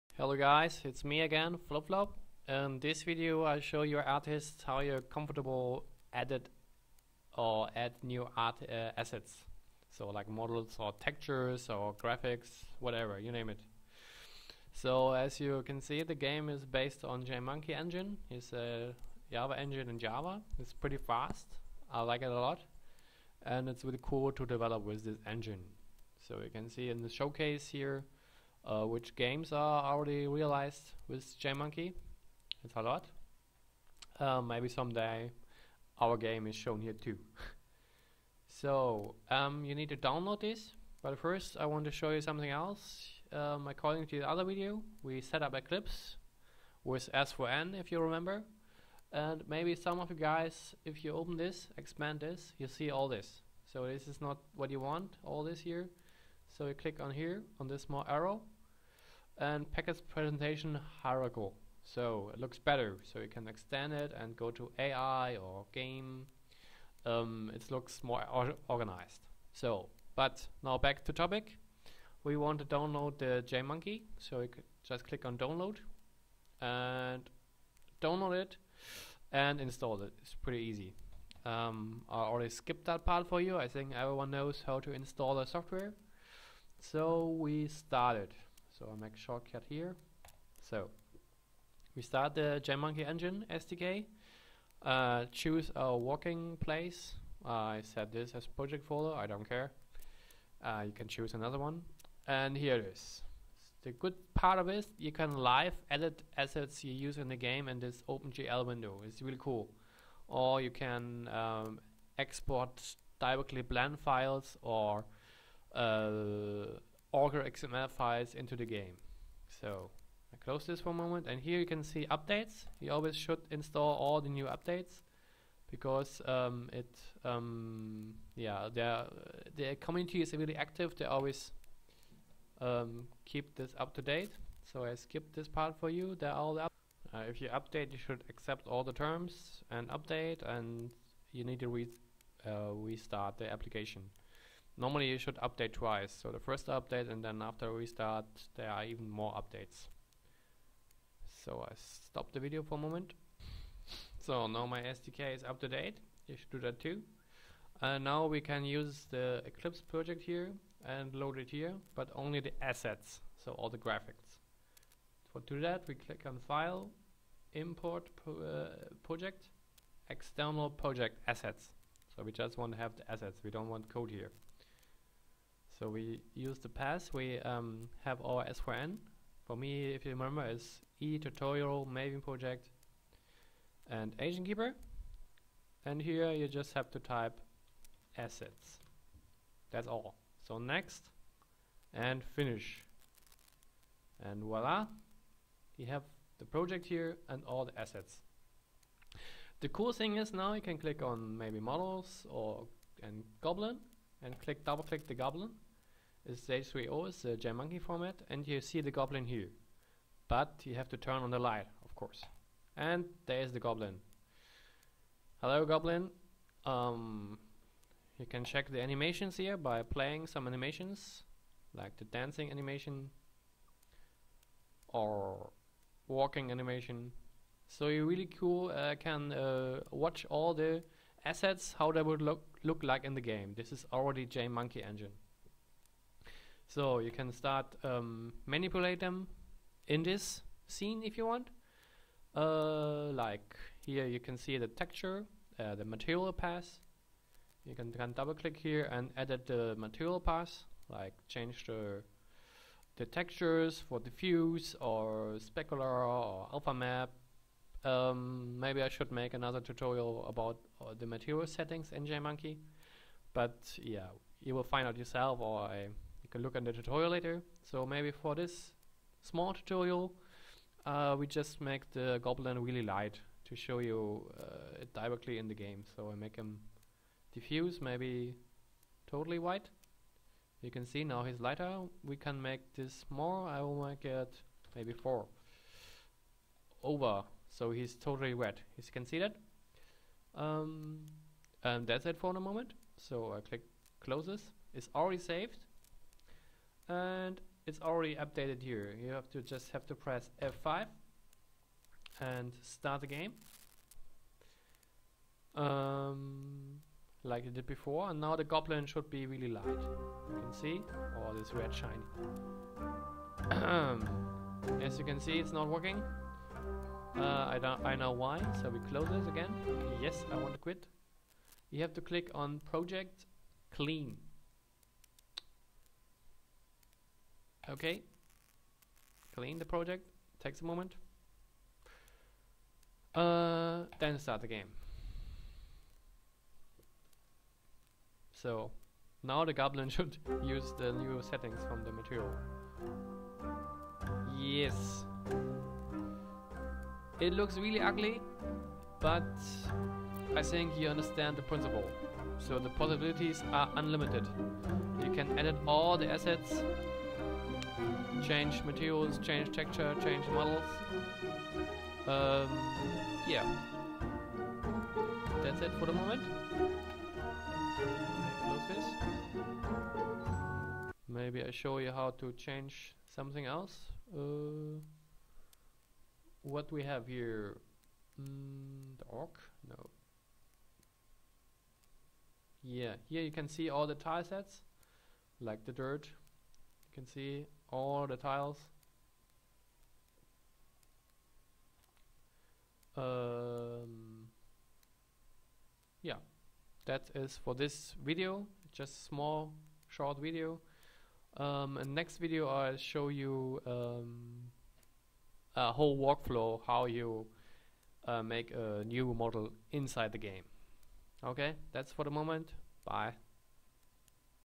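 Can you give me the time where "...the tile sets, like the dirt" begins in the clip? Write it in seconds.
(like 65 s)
383 s.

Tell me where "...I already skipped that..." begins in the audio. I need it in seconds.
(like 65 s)
82 s.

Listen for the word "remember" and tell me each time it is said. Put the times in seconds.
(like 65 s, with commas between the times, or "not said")
48 s, 180 s.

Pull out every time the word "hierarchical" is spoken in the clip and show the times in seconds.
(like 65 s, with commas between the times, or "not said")
61 s.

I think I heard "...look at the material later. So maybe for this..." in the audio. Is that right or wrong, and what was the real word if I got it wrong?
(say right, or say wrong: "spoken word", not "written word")
wrong: "tutorial", not "material".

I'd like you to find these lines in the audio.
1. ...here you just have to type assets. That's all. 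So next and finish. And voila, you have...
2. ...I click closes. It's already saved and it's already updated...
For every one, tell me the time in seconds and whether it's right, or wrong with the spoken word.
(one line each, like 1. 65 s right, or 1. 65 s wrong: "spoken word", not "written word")
1. 185 s right
2. 293 s right.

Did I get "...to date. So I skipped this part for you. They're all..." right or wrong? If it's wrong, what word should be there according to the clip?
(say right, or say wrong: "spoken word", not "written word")
right.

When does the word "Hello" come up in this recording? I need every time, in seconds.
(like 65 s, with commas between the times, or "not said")
0 s, 215 s.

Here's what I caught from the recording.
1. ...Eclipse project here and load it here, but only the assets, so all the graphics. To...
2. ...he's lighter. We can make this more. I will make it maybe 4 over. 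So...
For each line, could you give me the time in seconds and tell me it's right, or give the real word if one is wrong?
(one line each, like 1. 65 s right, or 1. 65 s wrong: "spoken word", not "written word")
1. 159 s right
2. 281 s right.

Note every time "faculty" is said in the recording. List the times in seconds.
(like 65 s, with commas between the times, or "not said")
not said.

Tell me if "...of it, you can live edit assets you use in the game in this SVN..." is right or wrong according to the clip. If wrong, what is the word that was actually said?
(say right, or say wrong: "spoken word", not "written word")
wrong: "OpenGL", not "SVN".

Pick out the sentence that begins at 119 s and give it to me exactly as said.
So I close this for a moment and here you can see updates.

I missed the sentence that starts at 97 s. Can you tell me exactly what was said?
Uh, I set this as project folder.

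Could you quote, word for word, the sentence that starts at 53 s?
So this is not what you want, all this here.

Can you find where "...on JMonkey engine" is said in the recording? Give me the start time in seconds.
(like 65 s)
17 s.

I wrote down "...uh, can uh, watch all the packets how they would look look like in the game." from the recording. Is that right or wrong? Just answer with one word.
wrong.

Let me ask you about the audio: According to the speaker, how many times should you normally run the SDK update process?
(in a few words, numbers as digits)
twice.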